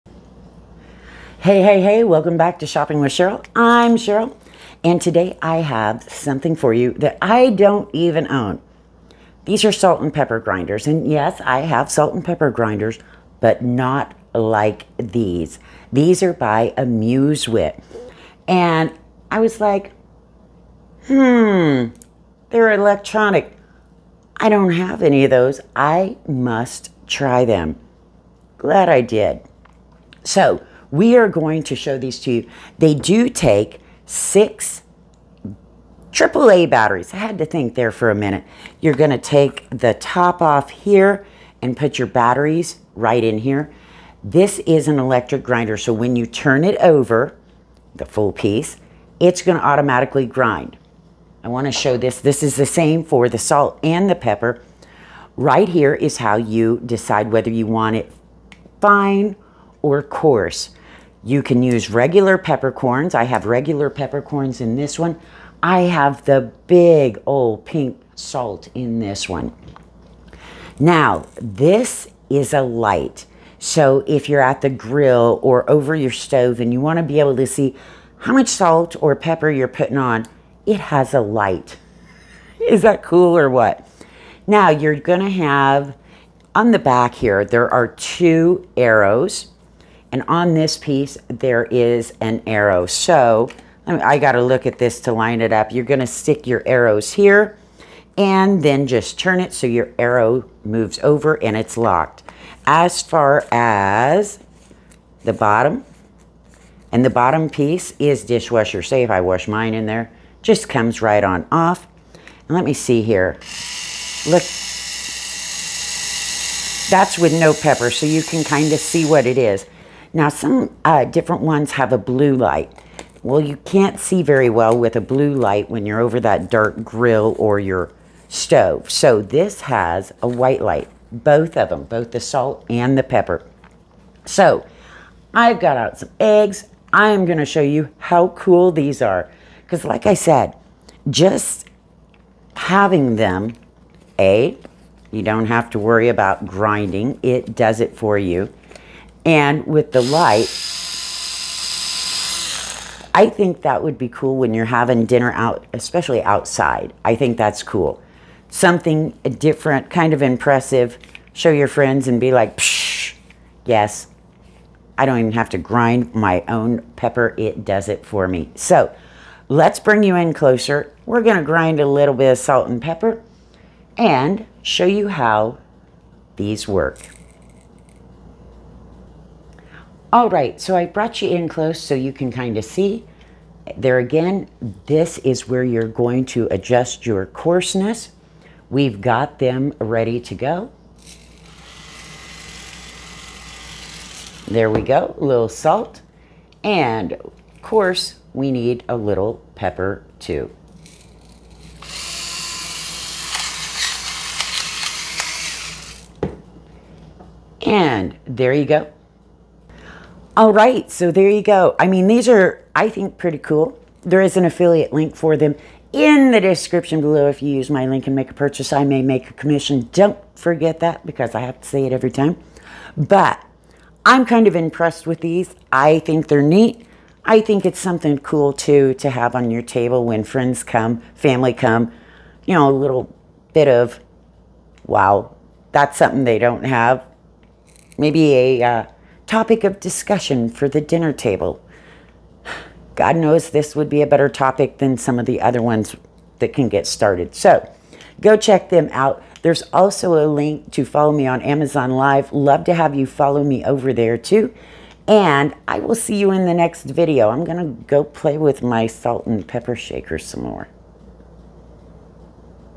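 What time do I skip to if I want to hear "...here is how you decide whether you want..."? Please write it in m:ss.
0:55.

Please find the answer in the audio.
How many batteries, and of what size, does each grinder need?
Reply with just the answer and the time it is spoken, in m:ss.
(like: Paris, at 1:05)
6 AAA batteries, at 0:34.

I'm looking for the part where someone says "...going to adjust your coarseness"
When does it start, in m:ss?
3:05.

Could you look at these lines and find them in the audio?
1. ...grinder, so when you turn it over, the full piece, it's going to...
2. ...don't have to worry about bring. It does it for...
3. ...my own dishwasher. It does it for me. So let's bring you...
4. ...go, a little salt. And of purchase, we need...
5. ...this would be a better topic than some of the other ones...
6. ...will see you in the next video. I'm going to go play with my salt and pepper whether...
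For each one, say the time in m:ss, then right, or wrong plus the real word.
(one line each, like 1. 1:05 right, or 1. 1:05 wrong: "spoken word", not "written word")
1. 0:45 right
2. 2:25 wrong: "grinding", not "bring"
3. 2:46 wrong: "pepper", not "dishwasher"
4. 3:14 wrong: "course", not "purchase"
5. 4:03 right
6. 4:15 wrong: "shaker", not "whether".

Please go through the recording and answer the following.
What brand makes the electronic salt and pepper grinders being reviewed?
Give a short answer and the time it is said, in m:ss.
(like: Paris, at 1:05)
AmuseWit, at 0:16.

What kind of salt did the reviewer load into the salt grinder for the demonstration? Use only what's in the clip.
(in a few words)
Pink salt.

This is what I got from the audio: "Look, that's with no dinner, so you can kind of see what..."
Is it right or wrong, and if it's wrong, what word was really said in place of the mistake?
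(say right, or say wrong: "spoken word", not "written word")
wrong: "pepper", not "dinner".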